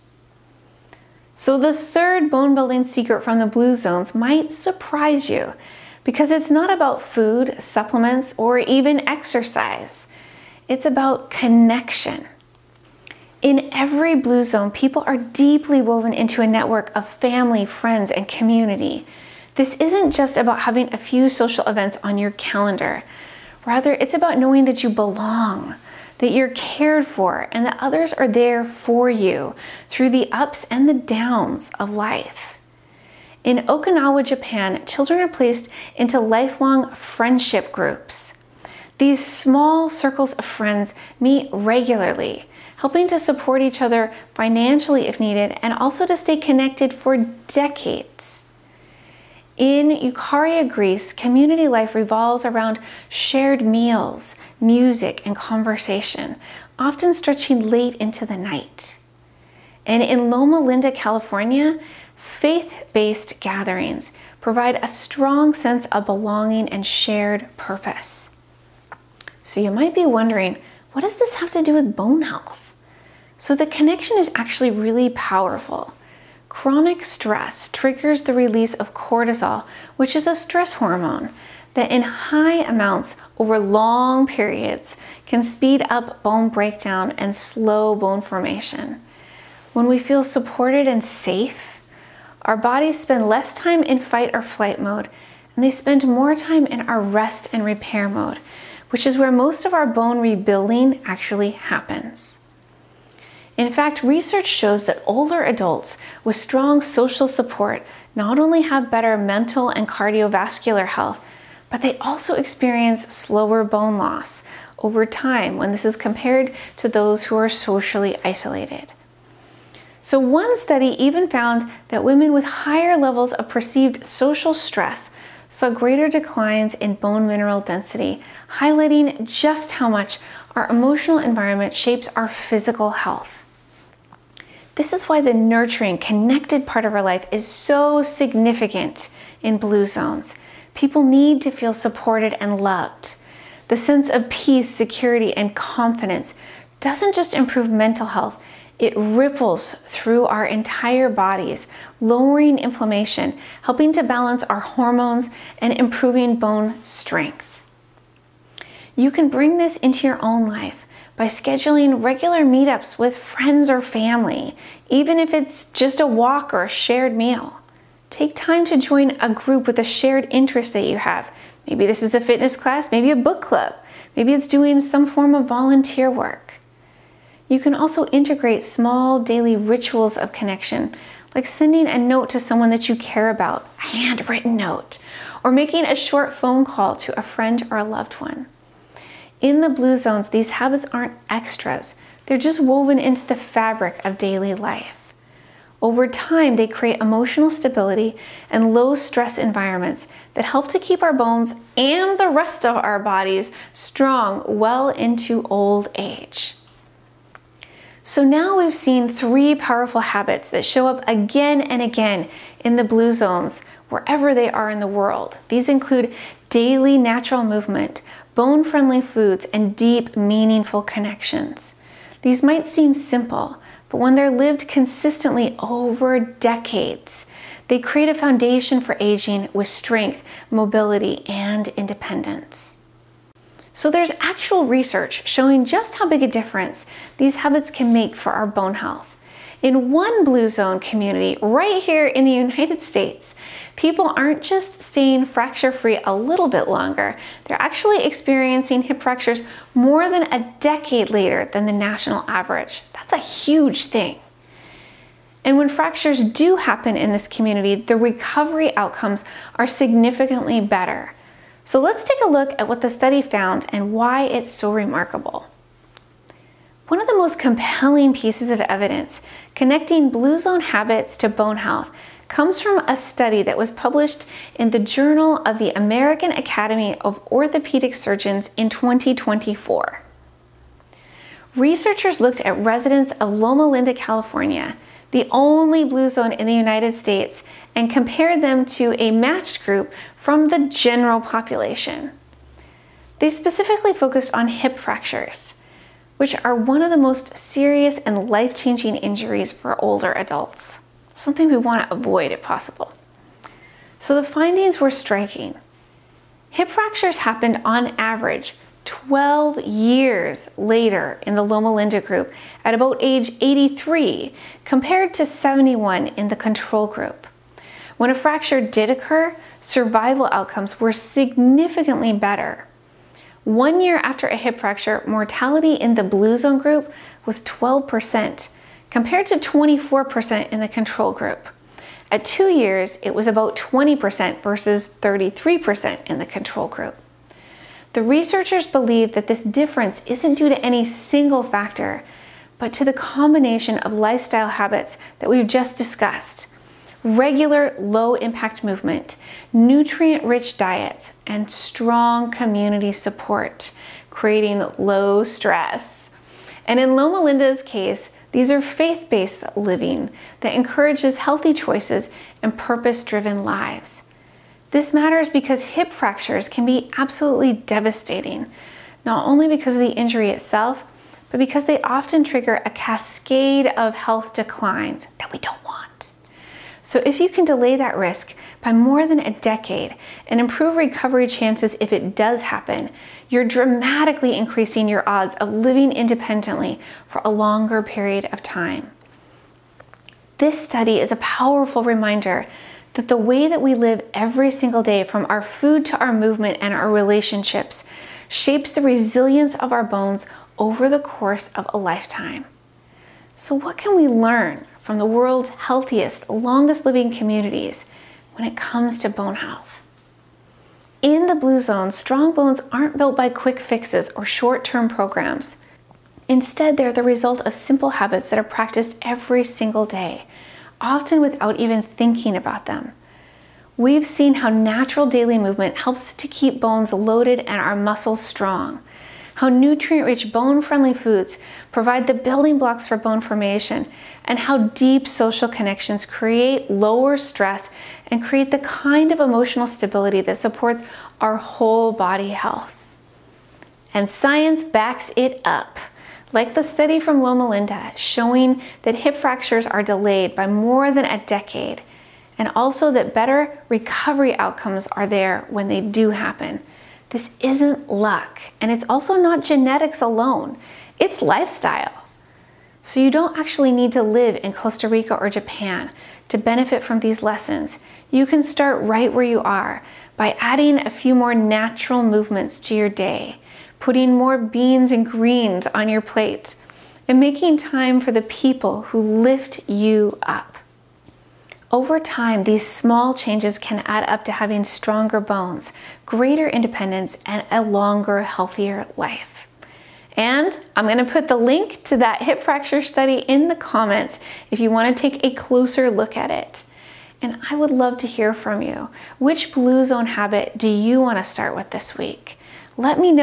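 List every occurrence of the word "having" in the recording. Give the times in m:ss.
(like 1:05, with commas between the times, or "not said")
0:20, 8:04.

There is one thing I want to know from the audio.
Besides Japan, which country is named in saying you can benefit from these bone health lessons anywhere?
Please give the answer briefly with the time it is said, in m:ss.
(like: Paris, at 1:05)
Costa Rica, at 7:44.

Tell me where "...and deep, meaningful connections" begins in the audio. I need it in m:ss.
3:39.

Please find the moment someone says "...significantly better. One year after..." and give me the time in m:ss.
5:20.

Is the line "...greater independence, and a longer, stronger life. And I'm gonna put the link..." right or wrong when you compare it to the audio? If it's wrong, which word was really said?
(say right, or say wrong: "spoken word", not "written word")
wrong: "healthier", not "stronger".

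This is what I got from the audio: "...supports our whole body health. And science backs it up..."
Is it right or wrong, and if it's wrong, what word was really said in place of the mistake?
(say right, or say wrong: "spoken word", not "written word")
right.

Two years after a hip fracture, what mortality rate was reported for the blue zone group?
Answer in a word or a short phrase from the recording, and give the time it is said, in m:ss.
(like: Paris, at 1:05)
about 20%, at 5:33.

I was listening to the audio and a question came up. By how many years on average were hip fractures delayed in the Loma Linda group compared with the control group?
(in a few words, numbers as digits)
12.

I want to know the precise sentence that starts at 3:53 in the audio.
So there's actual research showing just how big a difference these habits can make for our bone health.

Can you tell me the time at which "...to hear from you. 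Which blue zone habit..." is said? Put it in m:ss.
8:17.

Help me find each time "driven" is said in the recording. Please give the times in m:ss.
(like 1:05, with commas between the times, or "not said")
6:03.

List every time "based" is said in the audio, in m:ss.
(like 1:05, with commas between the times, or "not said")
1:02, 5:59.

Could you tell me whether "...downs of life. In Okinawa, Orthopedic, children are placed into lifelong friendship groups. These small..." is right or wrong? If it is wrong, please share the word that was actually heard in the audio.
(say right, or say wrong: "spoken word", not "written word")
wrong: "Japan", not "Orthopedic".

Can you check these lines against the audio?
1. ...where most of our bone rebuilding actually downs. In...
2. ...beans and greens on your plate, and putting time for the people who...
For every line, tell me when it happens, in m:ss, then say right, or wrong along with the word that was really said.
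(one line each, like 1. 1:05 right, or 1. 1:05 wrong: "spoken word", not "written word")
1. 1:39 wrong: "happens", not "downs"
2. 7:54 wrong: "making", not "putting".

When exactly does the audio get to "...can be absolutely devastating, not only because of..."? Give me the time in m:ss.
6:06.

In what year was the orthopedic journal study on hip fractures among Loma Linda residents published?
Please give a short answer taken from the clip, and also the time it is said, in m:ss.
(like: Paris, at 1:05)
2024, at 4:38.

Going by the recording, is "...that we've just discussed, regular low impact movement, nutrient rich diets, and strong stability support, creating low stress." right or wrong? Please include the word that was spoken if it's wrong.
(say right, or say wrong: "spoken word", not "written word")
wrong: "community", not "stability".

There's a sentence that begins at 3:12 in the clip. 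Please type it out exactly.
They're just woven into the fabric of daily life.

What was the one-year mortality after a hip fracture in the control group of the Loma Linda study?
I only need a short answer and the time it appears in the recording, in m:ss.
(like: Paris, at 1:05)
24%, at 5:29.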